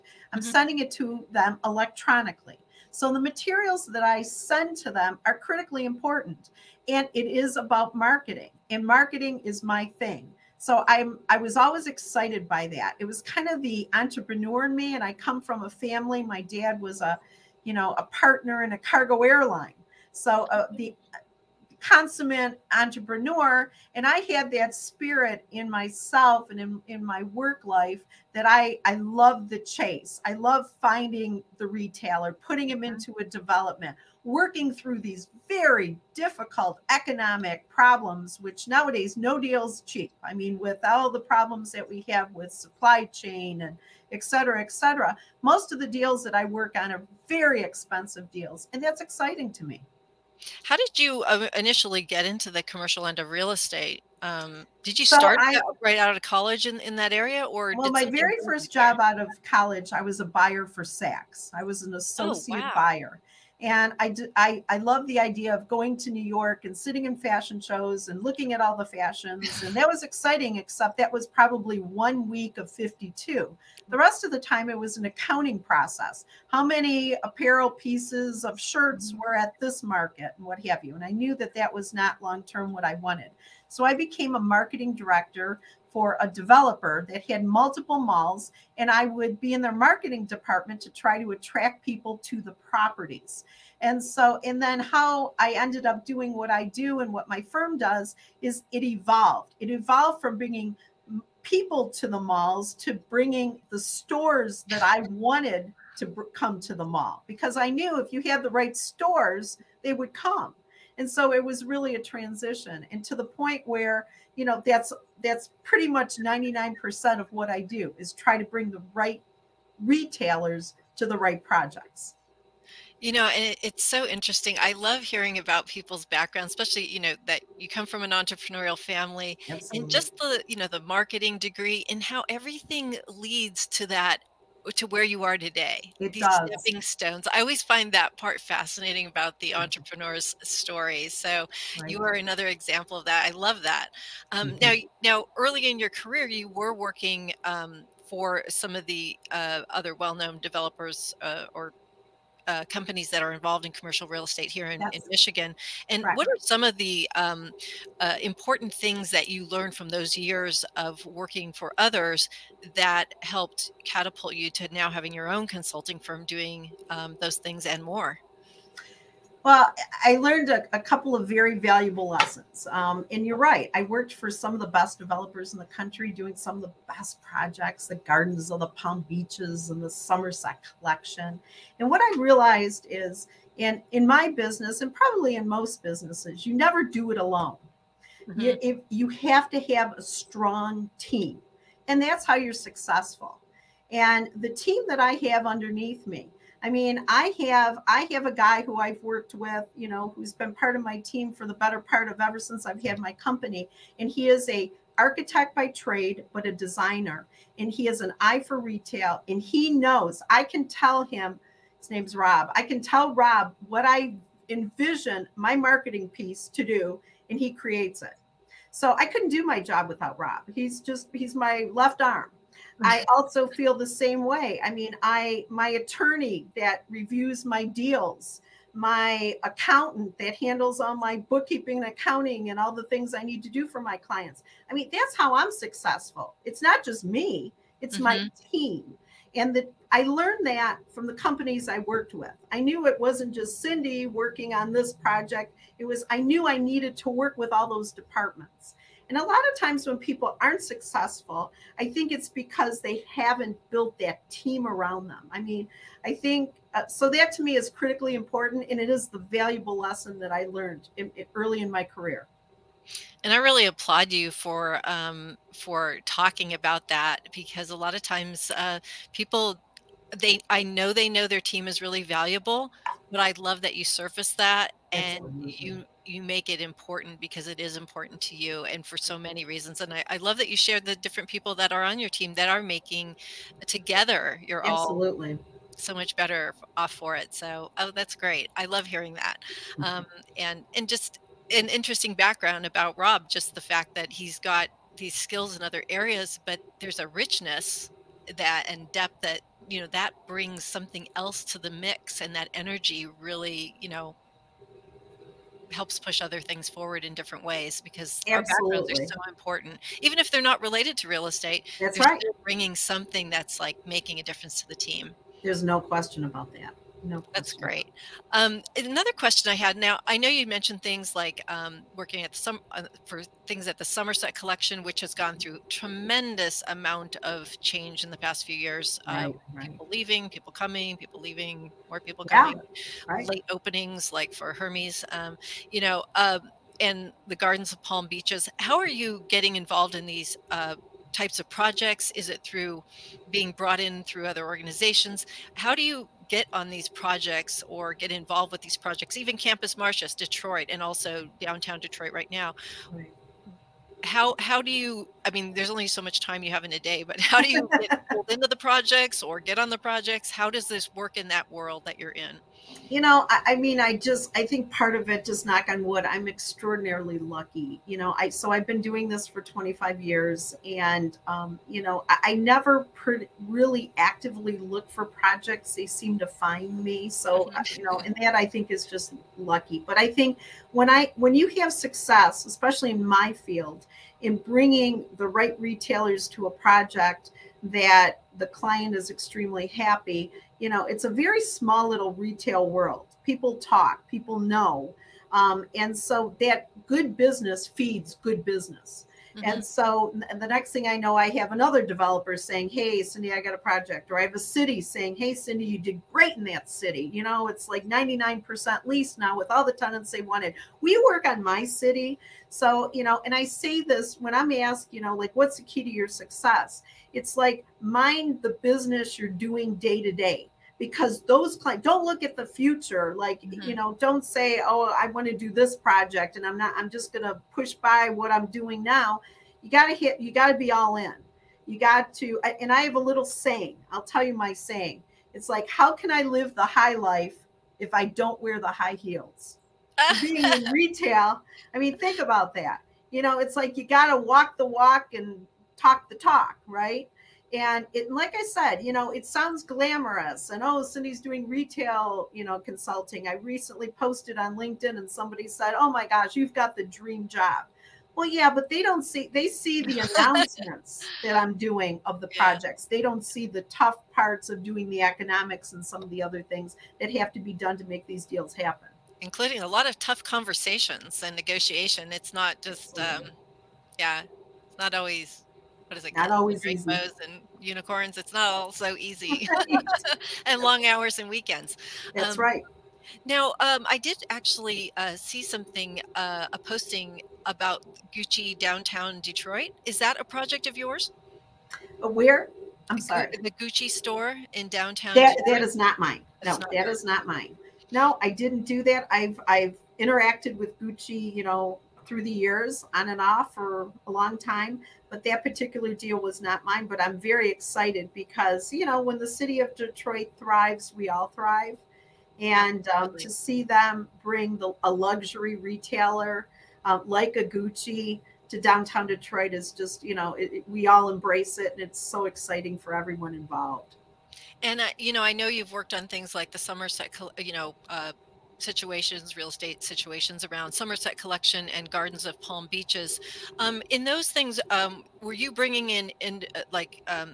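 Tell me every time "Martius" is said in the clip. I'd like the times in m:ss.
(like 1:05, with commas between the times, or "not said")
5:49.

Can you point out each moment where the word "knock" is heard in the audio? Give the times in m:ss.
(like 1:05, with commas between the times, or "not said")
6:05.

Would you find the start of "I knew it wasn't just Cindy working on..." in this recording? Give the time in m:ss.
4:02.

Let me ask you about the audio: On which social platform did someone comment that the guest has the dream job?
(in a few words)
LinkedIn.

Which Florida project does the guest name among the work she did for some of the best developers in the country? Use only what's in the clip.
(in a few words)
Gardens of the Palm Beaches.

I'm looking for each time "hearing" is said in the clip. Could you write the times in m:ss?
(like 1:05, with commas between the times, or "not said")
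2:05, 4:48.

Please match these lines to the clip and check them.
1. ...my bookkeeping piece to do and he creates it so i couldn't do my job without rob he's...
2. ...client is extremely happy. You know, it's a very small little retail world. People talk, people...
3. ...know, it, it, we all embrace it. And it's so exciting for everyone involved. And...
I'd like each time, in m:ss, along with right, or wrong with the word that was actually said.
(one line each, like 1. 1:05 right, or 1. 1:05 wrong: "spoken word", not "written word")
1. 3:35 wrong: "marketing", not "bookkeeping"
2. 6:28 right
3. 8:40 right.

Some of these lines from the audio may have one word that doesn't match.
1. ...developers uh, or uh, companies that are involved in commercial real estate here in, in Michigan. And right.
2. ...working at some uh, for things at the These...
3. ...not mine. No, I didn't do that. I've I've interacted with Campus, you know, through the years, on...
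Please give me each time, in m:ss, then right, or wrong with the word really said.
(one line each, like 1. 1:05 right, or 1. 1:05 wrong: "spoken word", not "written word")
1. 2:30 right
2. 5:21 wrong: "Somerset", not "These"
3. 8:17 wrong: "Gucci", not "Campus".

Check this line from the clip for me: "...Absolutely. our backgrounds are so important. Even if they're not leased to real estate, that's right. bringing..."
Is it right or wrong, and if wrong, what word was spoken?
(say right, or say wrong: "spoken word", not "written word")
wrong: "related", not "leased".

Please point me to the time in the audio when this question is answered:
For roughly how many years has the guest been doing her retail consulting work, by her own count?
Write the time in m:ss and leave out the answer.
6:09.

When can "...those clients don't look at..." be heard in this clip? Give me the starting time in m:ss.
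7:01.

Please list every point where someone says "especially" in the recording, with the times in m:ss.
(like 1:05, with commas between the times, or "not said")
2:06, 6:22.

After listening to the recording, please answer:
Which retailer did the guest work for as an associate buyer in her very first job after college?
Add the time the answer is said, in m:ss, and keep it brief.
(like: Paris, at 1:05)
Saks, at 1:00.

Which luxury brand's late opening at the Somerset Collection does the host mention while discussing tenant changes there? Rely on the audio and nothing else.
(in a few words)
Hermes.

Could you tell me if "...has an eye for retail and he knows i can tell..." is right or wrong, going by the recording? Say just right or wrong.
right.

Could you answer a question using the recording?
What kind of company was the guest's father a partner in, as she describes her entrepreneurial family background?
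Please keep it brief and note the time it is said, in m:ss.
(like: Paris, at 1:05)
cargo airline, at 0:18.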